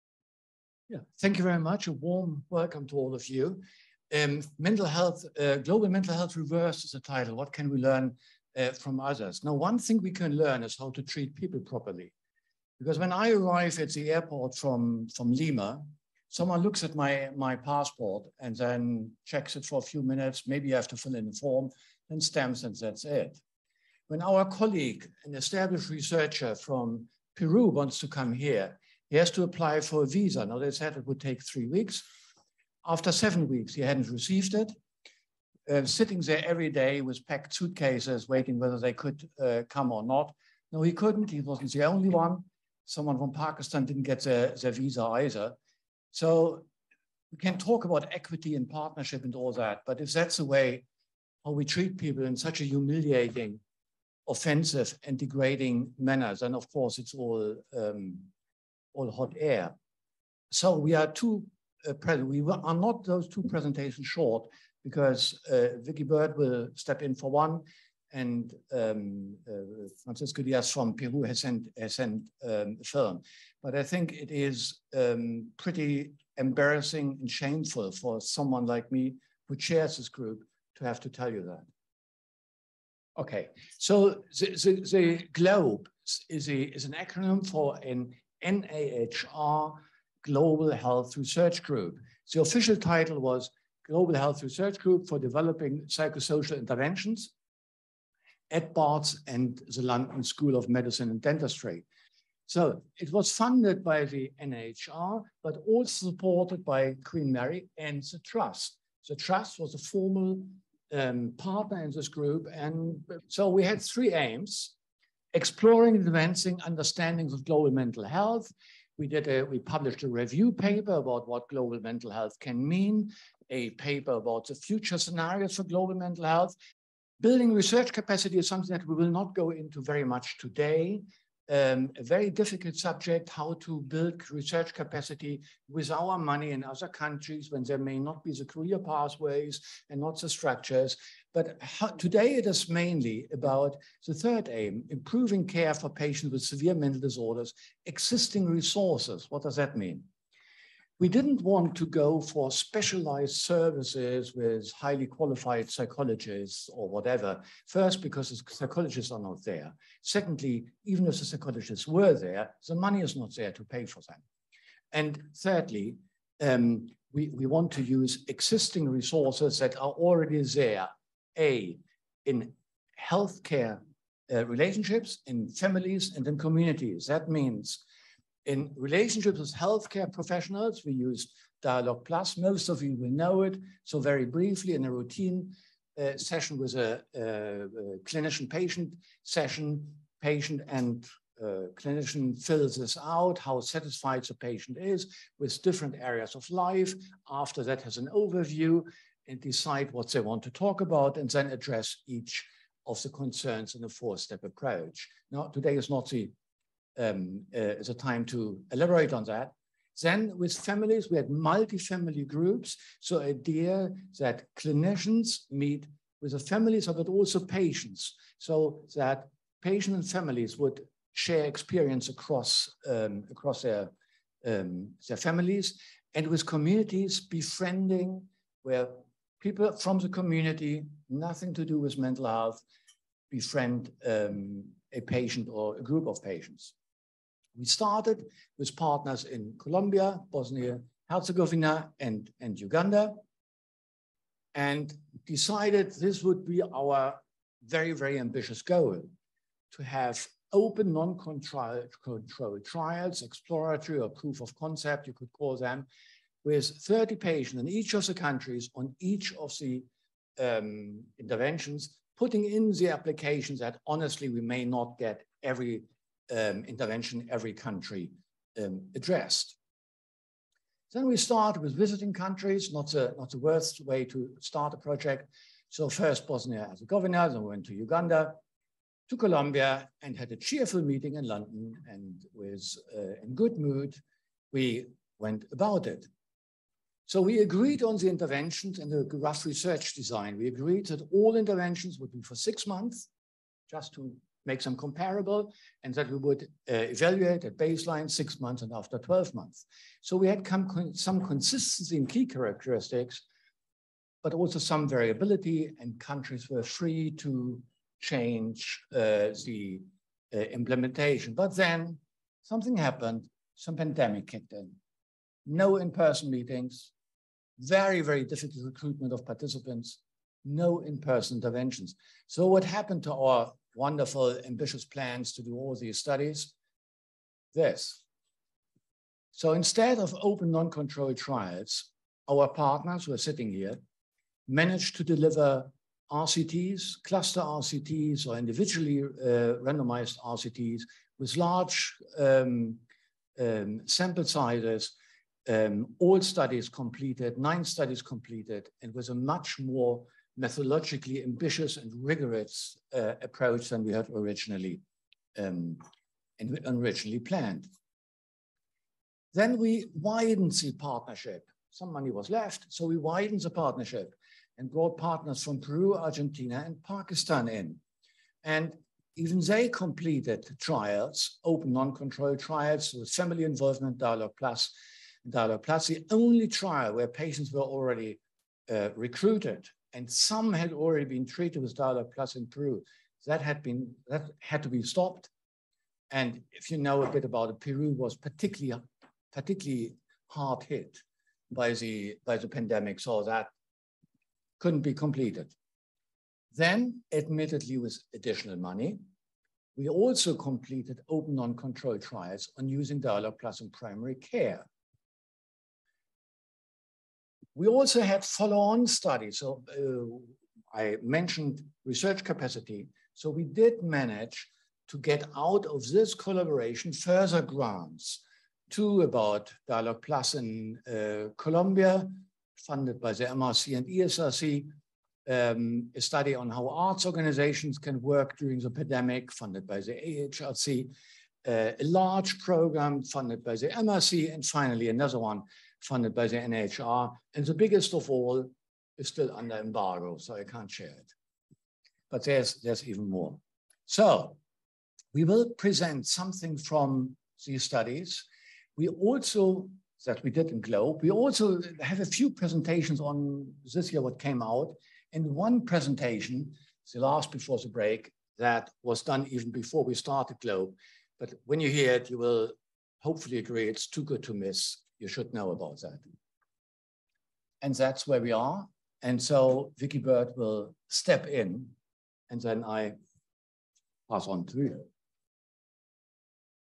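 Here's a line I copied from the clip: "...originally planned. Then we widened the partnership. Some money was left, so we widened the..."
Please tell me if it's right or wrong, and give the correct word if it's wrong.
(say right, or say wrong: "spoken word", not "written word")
right.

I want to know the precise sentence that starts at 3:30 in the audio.
Then with families, we had multi-family groups.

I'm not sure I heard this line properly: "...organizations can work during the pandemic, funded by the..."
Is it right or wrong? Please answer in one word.
right.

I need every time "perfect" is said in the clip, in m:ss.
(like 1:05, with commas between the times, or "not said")
not said.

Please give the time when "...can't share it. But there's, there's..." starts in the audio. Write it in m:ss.
7:20.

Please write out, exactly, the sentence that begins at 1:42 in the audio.
So it was funded by the NIHR, but also supported by Queen Mary and the Trust.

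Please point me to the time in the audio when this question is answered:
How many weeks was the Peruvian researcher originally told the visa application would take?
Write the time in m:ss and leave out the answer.
0:31.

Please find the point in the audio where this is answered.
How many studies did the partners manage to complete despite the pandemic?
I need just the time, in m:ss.
5:47.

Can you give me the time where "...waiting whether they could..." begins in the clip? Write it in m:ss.
0:38.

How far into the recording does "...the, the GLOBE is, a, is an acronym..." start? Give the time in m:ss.
1:24.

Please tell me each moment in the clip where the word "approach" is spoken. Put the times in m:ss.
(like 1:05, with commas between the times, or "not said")
3:24, 5:53.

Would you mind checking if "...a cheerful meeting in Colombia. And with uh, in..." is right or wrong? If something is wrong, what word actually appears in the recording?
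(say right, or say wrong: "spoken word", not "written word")
wrong: "London", not "Colombia".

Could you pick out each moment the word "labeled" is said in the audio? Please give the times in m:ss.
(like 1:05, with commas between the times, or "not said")
not said.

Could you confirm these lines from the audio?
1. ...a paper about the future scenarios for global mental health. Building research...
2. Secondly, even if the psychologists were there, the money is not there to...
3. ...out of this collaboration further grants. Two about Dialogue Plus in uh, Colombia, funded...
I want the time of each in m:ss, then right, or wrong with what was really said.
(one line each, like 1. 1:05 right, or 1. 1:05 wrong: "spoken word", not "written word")
1. 2:03 right
2. 2:40 right
3. 6:55 right.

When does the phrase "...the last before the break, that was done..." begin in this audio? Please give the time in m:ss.
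7:36.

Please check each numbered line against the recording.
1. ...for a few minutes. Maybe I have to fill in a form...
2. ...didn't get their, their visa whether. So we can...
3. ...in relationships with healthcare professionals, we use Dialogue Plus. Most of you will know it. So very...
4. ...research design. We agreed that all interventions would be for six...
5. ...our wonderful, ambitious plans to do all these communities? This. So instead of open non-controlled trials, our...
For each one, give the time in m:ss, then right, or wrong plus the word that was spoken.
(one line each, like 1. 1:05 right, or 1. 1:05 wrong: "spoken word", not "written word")
1. 0:19 right
2. 0:43 wrong: "either", not "whether"
3. 2:58 right
4. 4:49 right
5. 5:23 wrong: "studies", not "communities".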